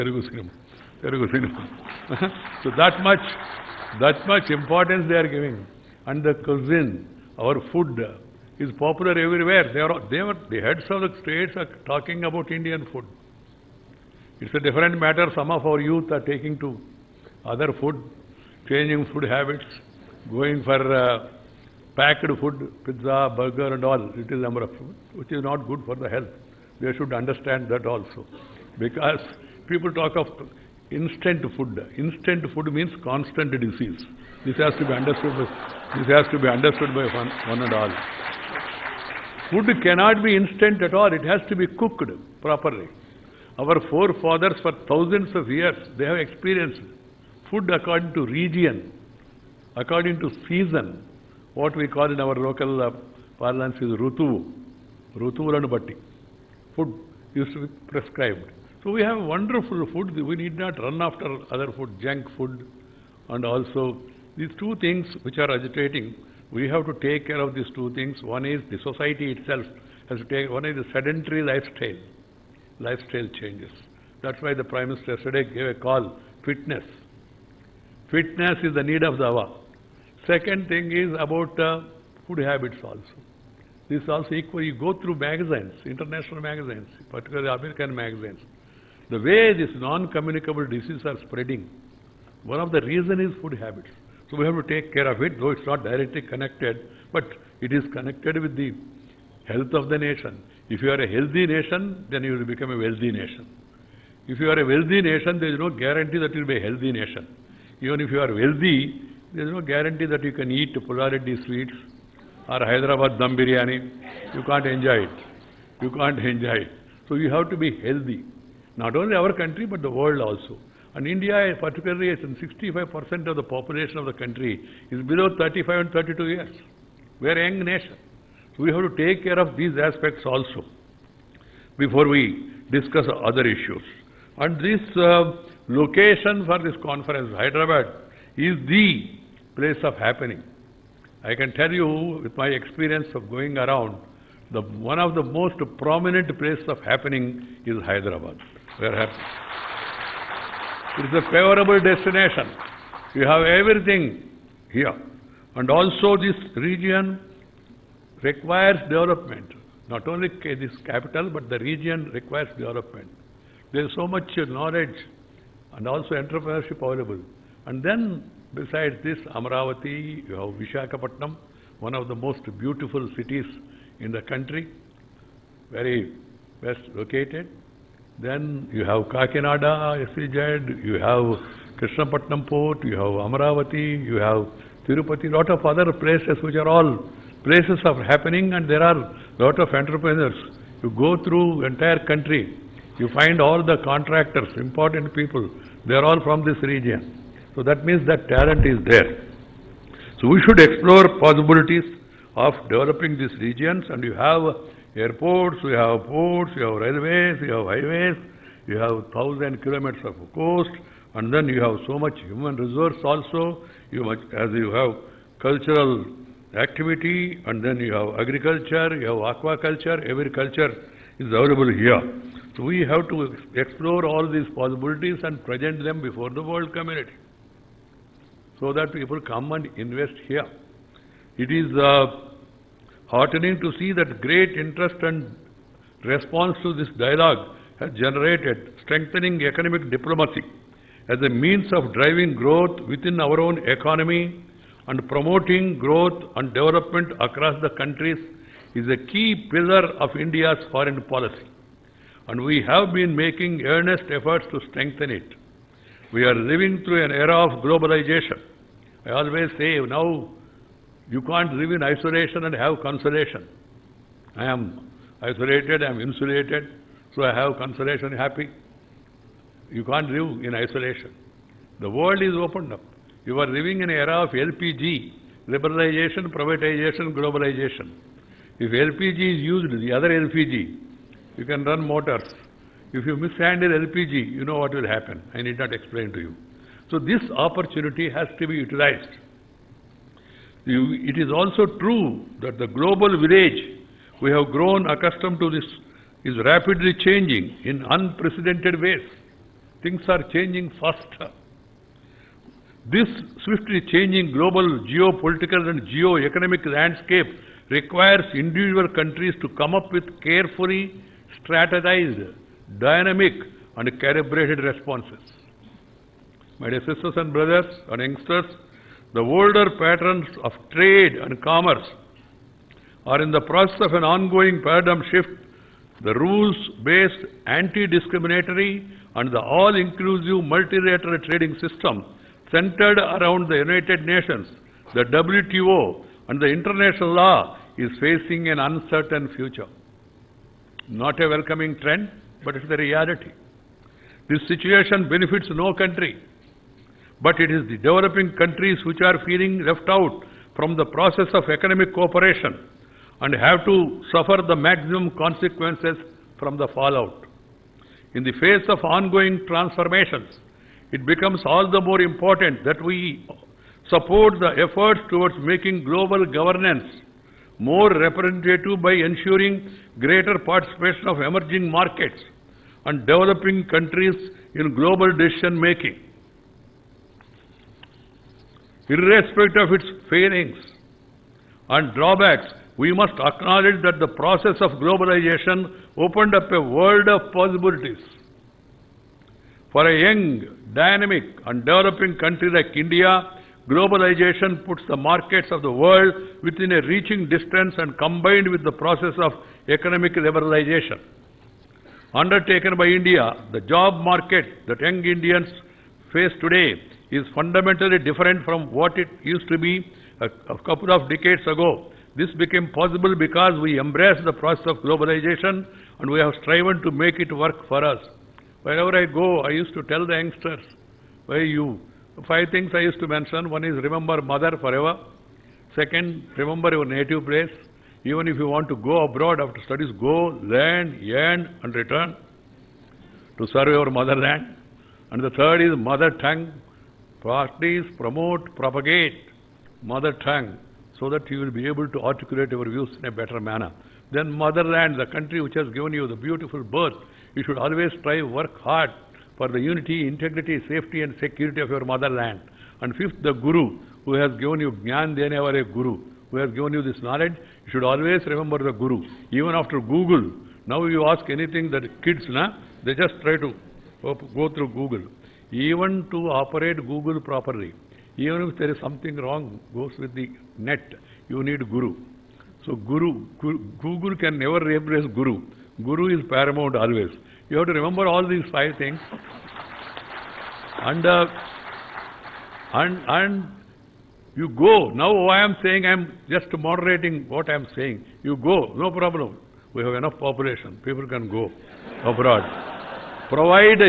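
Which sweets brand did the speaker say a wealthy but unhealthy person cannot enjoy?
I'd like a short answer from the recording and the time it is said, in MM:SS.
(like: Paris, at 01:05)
Pulla Reddy sweets, at 01:50.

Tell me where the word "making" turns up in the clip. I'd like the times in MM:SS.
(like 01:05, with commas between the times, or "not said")
04:13, 06:05, 06:15.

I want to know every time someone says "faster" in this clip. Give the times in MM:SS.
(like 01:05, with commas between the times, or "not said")
05:00.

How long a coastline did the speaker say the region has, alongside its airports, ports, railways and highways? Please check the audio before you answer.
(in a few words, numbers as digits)
1000 kilometers.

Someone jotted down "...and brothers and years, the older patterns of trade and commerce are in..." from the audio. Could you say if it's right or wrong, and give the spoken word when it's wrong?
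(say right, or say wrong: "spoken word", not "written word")
wrong: "youngsters", not "years".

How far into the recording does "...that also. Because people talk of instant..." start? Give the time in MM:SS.
00:27.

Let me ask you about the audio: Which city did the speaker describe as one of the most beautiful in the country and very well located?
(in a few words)
Vishakhapatnam.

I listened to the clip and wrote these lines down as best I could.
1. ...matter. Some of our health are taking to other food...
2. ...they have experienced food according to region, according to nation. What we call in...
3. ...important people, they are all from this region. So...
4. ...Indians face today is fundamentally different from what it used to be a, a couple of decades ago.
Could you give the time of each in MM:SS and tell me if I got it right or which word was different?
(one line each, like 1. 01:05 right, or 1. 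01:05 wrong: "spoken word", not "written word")
1. 00:14 wrong: "youth", not "health"
2. 00:45 wrong: "season", not "nation"
3. 03:14 right
4. 06:45 right.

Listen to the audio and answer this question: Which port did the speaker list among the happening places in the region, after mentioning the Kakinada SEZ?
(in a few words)
Krishnapatnam port.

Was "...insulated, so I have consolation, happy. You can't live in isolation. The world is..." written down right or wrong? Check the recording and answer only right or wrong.
right.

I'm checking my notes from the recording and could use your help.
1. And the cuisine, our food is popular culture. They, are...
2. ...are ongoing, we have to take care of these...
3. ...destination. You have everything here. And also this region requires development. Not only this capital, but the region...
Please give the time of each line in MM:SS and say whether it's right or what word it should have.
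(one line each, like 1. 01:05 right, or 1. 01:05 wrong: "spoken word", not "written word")
1. 00:06 wrong: "everywhere", not "culture"
2. 01:05 wrong: "agitating", not "ongoing"
3. 02:31 right.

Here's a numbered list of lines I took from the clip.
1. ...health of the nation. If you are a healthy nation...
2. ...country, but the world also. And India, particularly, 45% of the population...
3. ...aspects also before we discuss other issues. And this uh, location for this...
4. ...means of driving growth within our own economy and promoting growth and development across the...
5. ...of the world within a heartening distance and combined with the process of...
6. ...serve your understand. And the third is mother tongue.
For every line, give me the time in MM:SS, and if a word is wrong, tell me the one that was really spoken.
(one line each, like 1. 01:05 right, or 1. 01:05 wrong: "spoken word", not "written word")
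1. 01:39 right
2. 01:59 wrong: "65", not "45"
3. 02:09 right
4. 04:01 right
5. 06:35 wrong: "reaching", not "heartening"
6. 07:13 wrong: "motherland", not "understand".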